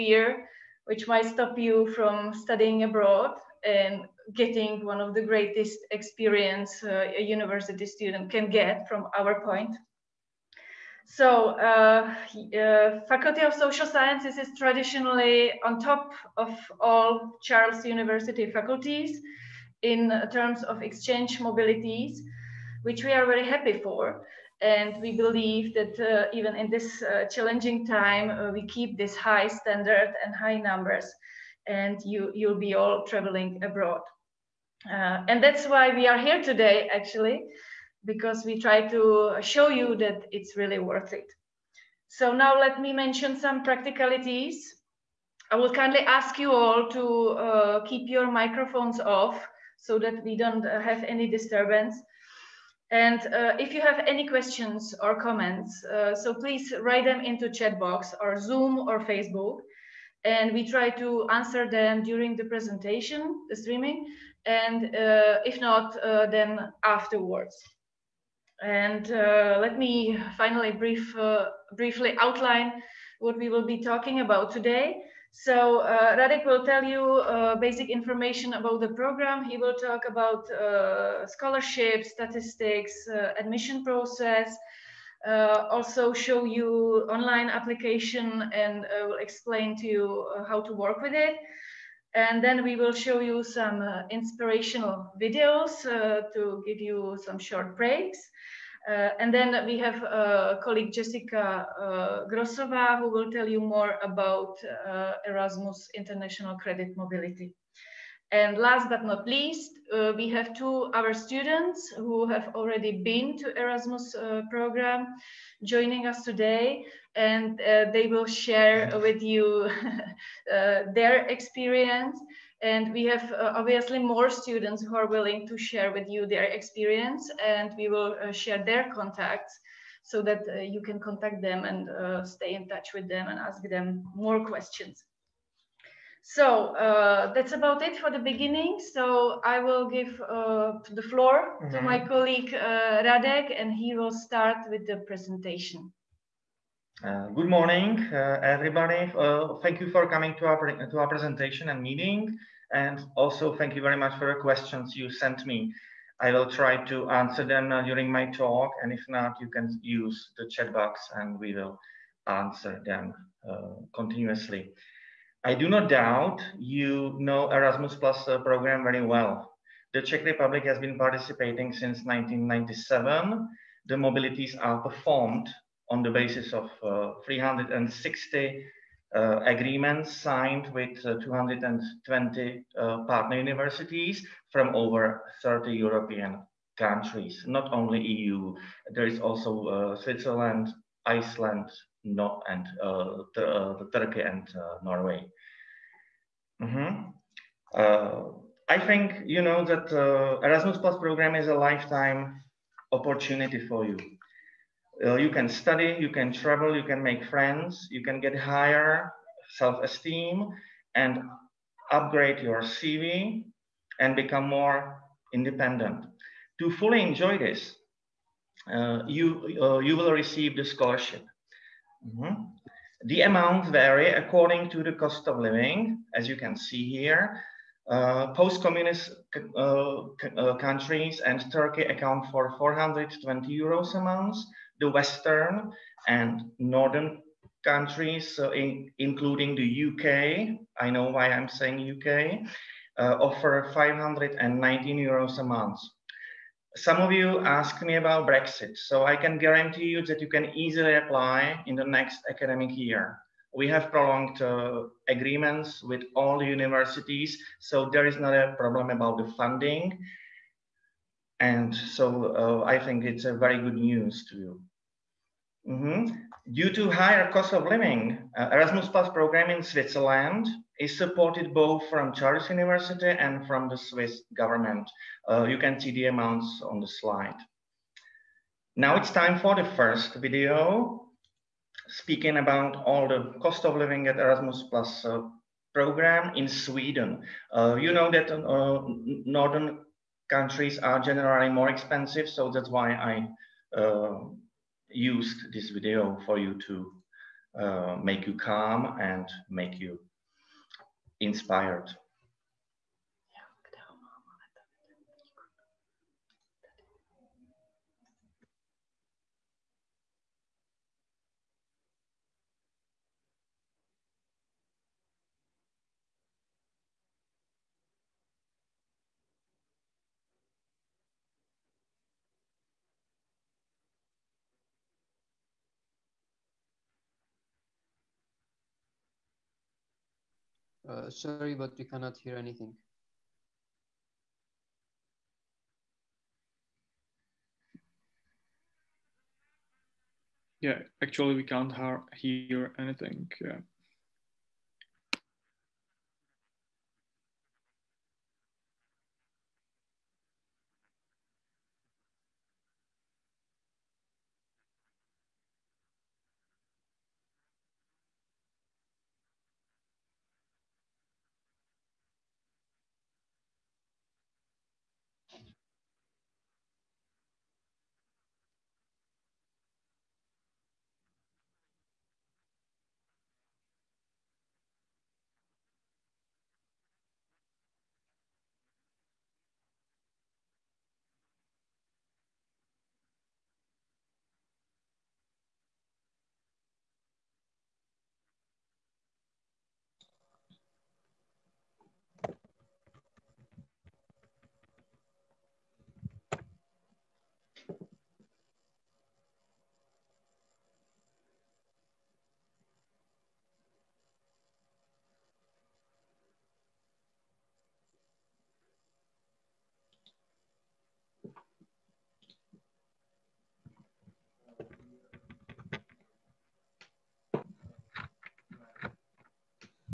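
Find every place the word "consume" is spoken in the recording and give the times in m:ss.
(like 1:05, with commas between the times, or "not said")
not said.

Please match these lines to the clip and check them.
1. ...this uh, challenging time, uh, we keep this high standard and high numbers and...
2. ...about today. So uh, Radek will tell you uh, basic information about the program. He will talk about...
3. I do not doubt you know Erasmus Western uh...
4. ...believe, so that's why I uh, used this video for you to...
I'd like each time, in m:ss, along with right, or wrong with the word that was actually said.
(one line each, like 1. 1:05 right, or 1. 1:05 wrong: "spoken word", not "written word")
1. 0:26 right
2. 1:14 right
3. 2:45 wrong: "Plus", not "Western"
4. 4:51 wrong: "expensive", not "believe".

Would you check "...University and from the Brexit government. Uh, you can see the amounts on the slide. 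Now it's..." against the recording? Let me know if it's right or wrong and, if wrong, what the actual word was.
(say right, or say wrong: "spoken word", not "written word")
wrong: "Swiss", not "Brexit".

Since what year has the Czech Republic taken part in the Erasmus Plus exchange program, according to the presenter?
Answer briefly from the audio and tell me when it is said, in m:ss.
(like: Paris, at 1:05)
1997, at 2:52.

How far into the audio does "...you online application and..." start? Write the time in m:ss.
1:26.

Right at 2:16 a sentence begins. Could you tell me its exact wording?
So uh, that's about it for the beginning.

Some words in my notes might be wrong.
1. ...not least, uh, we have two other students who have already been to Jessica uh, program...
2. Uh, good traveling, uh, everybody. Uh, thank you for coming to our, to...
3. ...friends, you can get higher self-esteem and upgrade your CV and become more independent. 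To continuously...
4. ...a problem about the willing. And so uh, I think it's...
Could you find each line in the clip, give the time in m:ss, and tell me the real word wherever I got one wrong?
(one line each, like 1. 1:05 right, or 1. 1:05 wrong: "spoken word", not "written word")
1. 1:49 wrong: "Erasmus", not "Jessica"
2. 2:27 wrong: "morning", not "traveling"
3. 3:27 wrong: "fully", not "continuously"
4. 4:18 wrong: "funding", not "willing".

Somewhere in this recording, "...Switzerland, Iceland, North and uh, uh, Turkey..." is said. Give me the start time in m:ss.
3:09.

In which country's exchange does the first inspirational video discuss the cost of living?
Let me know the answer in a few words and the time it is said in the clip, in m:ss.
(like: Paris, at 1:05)
Sweden, at 4:46.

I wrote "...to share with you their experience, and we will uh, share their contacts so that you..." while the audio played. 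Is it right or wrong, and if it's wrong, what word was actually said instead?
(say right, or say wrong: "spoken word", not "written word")
right.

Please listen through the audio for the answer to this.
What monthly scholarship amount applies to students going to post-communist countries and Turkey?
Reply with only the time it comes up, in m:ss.
3:52.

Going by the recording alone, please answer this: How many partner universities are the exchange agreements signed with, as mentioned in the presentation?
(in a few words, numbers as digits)
220.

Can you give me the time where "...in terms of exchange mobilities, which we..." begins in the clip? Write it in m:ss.
0:19.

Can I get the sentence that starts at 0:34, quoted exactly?
Uh, and that's why we are here today, actually, because we try to show you that it's really worth it.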